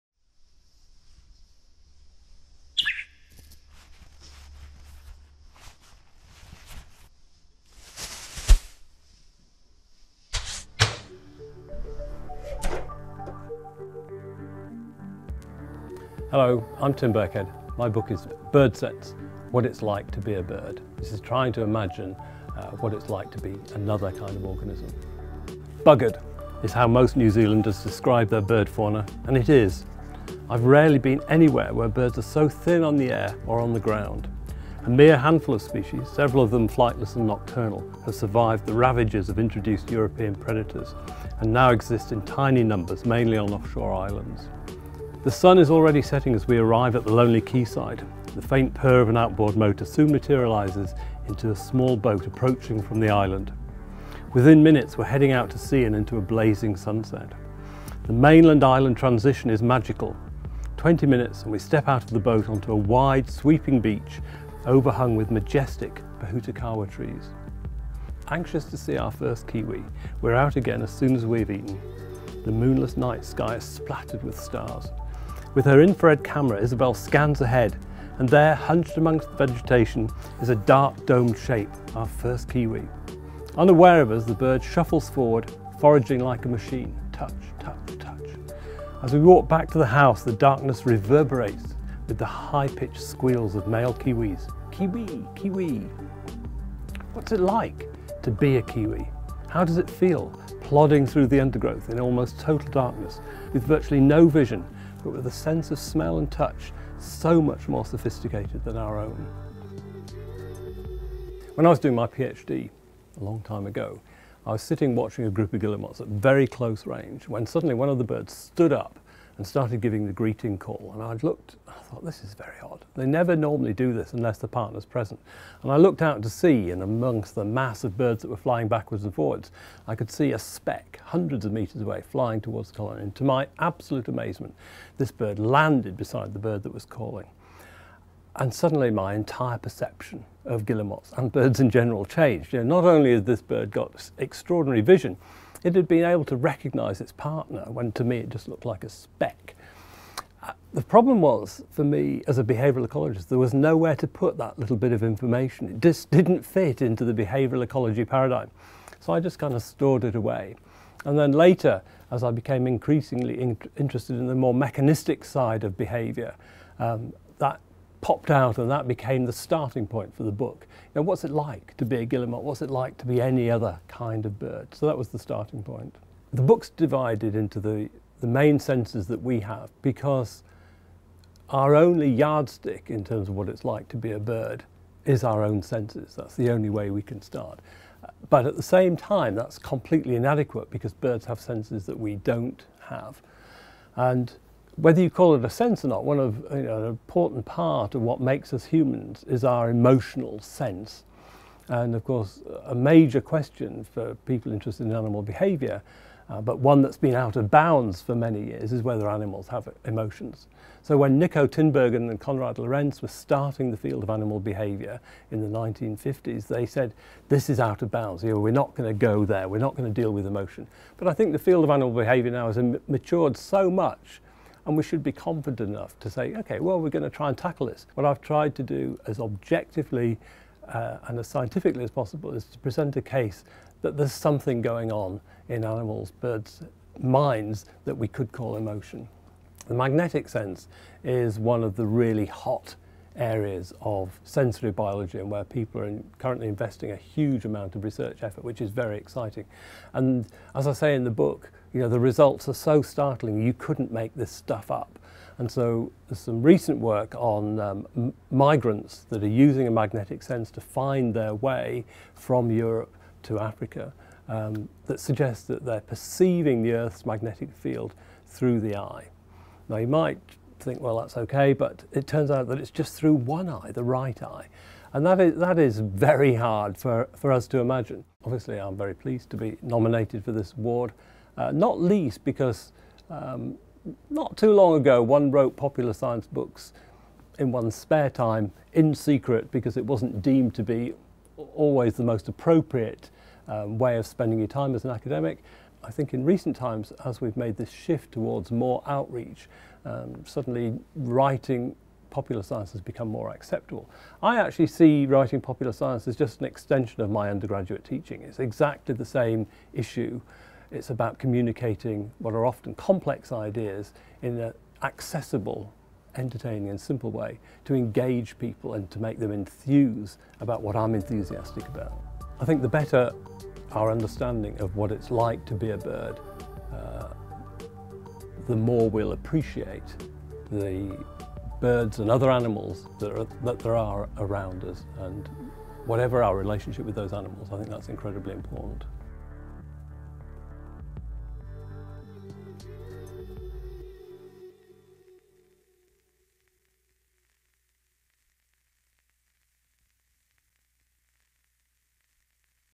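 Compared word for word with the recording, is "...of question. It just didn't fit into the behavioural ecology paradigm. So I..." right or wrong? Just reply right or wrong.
wrong.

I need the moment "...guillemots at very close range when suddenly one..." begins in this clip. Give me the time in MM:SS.
01:55.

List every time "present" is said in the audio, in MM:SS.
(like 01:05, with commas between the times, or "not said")
02:04, 03:52.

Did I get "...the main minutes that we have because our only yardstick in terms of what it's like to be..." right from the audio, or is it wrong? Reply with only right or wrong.
wrong.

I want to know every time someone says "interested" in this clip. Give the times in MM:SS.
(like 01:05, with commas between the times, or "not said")
02:43, 03:24.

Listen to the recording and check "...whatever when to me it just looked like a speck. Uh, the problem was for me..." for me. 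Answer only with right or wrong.
wrong.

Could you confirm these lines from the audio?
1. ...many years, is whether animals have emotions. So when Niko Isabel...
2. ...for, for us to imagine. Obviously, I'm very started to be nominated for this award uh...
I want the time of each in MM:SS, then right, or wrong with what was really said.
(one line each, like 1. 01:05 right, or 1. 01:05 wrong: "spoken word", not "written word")
1. 03:28 wrong: "Tinbergen", not "Isabel"
2. 04:36 wrong: "pleased", not "started".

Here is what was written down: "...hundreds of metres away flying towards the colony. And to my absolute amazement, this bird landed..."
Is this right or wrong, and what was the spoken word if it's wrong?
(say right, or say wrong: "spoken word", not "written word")
right.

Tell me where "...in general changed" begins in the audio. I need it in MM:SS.
02:21.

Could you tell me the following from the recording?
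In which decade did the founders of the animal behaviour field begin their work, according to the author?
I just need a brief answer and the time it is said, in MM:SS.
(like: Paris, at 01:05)
1950s, at 03:35.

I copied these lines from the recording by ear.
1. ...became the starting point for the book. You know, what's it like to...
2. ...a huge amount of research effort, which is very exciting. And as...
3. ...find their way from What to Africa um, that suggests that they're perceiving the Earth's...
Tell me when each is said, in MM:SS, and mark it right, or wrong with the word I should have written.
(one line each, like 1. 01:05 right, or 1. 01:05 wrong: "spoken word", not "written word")
1. 02:48 right
2. 04:06 right
3. 04:20 wrong: "Europe", not "What".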